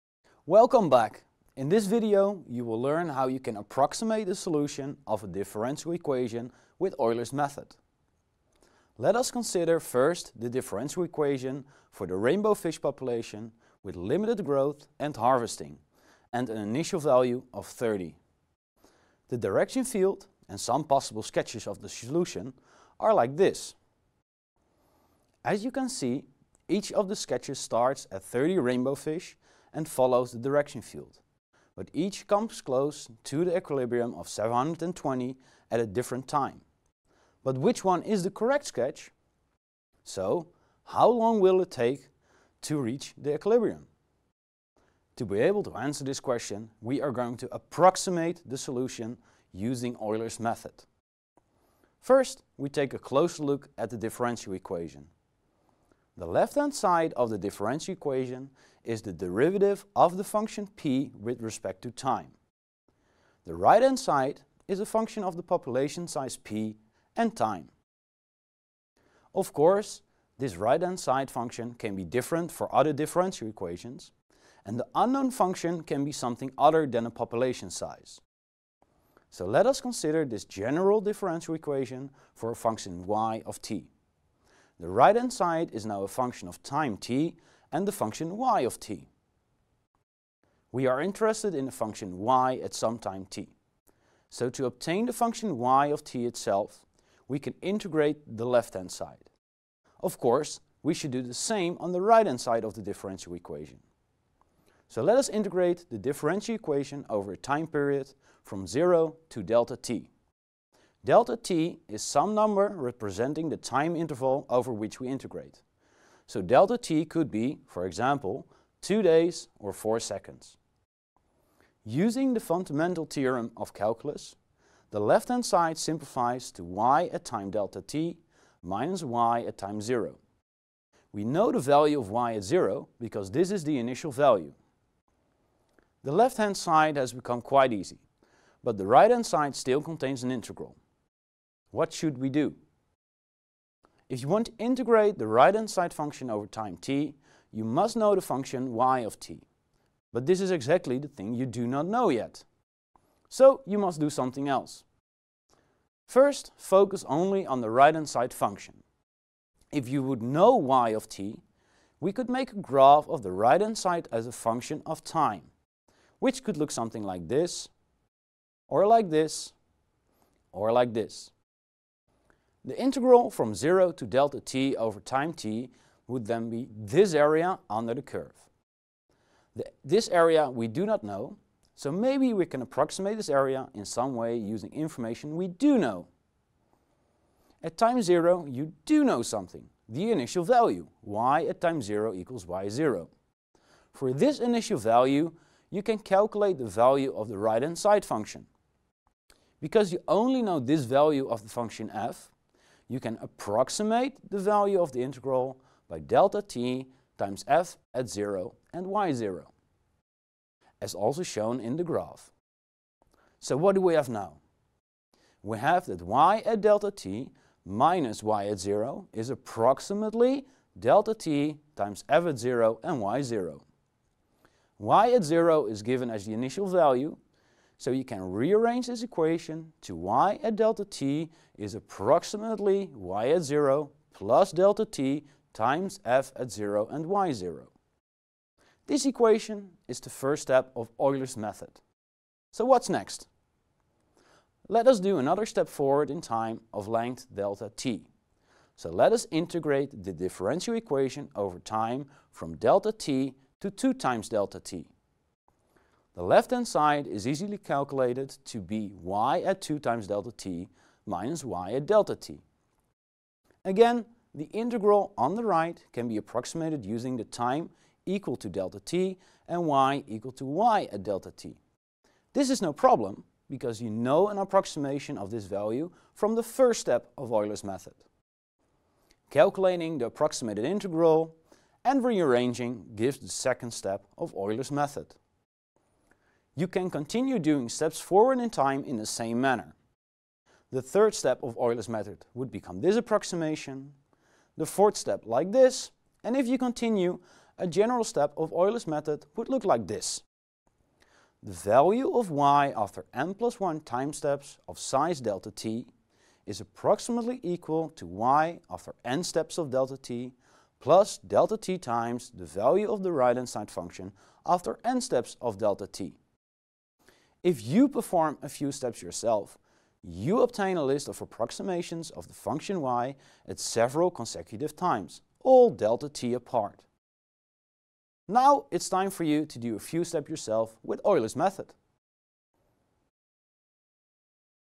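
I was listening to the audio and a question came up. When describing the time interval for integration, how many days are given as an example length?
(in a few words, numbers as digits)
2.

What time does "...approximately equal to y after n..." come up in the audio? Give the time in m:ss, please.
5:06.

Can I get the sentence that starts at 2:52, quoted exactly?
The integral from 0 to delta t over time t would then be this area under the curve.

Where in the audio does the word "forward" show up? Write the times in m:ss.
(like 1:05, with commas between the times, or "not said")
4:05, 4:48.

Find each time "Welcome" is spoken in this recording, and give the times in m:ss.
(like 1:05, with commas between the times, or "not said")
0:00.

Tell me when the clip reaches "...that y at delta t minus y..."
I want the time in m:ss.
3:35.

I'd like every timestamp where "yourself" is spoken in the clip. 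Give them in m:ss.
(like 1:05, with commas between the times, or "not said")
5:19, 5:30.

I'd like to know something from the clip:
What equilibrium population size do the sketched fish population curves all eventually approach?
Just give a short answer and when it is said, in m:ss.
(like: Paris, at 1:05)
720, at 0:34.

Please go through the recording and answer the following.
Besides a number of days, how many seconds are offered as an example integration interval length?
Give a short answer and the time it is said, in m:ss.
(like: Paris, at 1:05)
4 seconds, at 1:59.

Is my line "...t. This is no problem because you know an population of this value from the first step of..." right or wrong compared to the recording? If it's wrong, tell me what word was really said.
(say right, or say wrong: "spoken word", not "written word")
wrong: "approximation", not "population".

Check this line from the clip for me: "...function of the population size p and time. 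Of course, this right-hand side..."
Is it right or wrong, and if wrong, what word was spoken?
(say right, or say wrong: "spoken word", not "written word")
right.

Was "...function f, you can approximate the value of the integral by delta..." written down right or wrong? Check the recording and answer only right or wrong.
right.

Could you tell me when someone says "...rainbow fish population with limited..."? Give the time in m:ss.
0:12.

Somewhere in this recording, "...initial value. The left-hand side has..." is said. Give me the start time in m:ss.
2:13.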